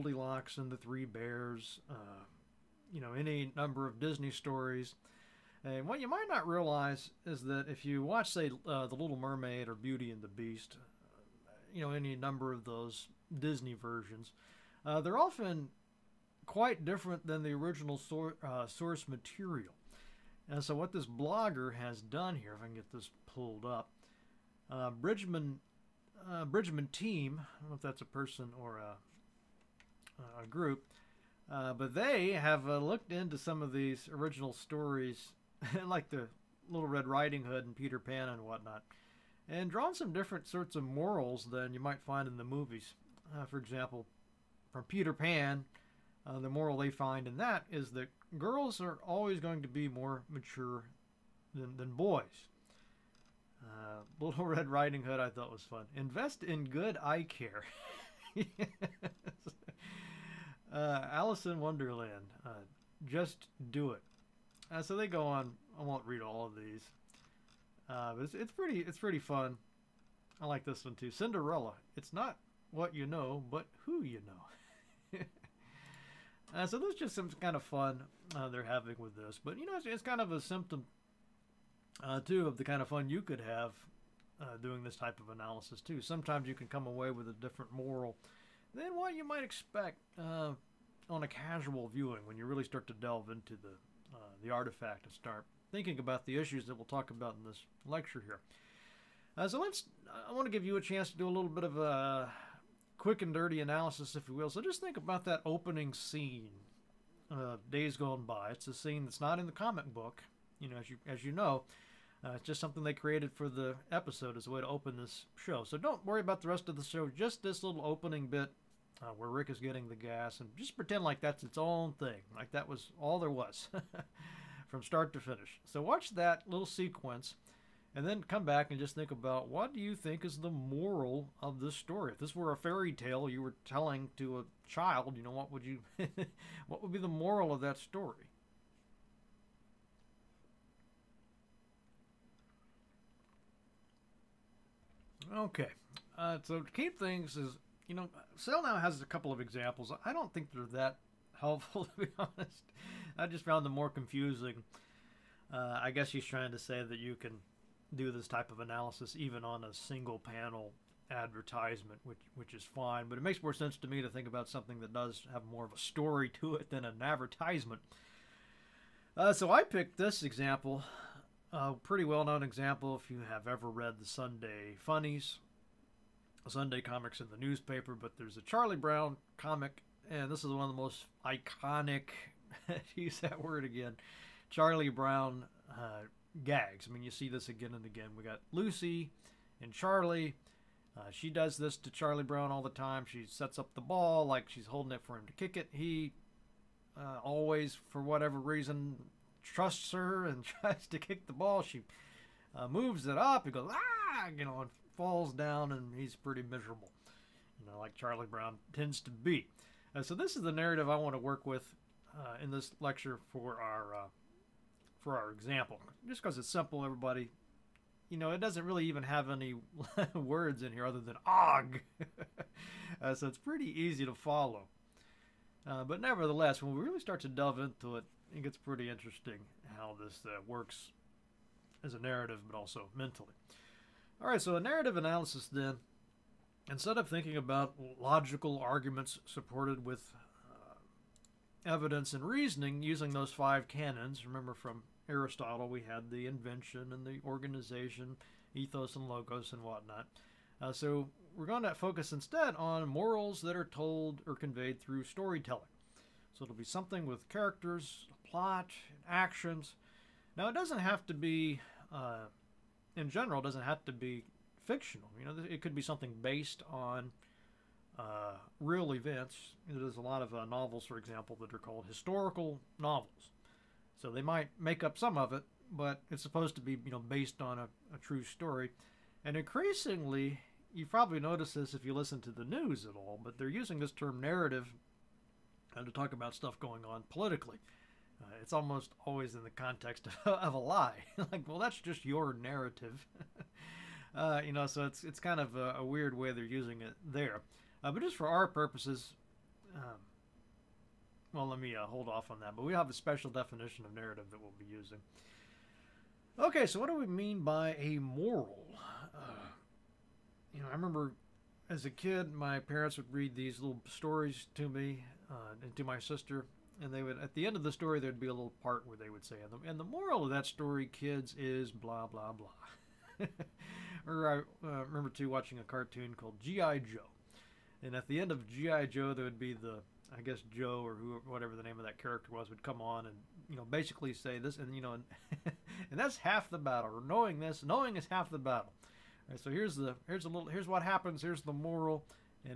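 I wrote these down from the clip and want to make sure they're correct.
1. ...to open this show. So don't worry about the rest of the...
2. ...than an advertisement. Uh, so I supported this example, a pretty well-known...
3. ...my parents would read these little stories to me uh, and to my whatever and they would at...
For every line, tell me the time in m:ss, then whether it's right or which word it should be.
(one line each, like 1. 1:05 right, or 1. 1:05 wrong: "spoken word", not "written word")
1. 1:54 right
2. 2:46 wrong: "picked", not "supported"
3. 5:12 wrong: "sister", not "whatever".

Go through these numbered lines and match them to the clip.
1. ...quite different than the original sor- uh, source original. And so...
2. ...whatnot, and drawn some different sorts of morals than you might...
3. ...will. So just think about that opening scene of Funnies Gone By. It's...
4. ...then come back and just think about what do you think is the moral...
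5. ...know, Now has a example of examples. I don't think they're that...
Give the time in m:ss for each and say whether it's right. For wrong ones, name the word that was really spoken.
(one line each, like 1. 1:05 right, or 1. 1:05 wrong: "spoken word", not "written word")
1. 0:16 wrong: "material", not "original"
2. 0:38 right
3. 1:44 wrong: "Days", not "Funnies"
4. 2:08 right
5. 2:27 wrong: "couple", not "example".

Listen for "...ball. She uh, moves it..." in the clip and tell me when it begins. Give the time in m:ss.
3:21.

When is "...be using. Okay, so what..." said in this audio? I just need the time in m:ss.
5:04.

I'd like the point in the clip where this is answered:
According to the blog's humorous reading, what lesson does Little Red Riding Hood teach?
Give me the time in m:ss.
0:55.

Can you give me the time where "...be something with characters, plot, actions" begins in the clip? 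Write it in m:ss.
4:16.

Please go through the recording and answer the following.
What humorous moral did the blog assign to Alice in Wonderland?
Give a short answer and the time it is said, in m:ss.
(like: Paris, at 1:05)
Just do it, at 1:03.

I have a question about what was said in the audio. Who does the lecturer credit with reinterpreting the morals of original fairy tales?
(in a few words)
Bridgman Team.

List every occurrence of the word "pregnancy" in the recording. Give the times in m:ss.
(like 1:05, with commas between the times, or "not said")
not said.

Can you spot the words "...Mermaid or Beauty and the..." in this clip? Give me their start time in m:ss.
0:09.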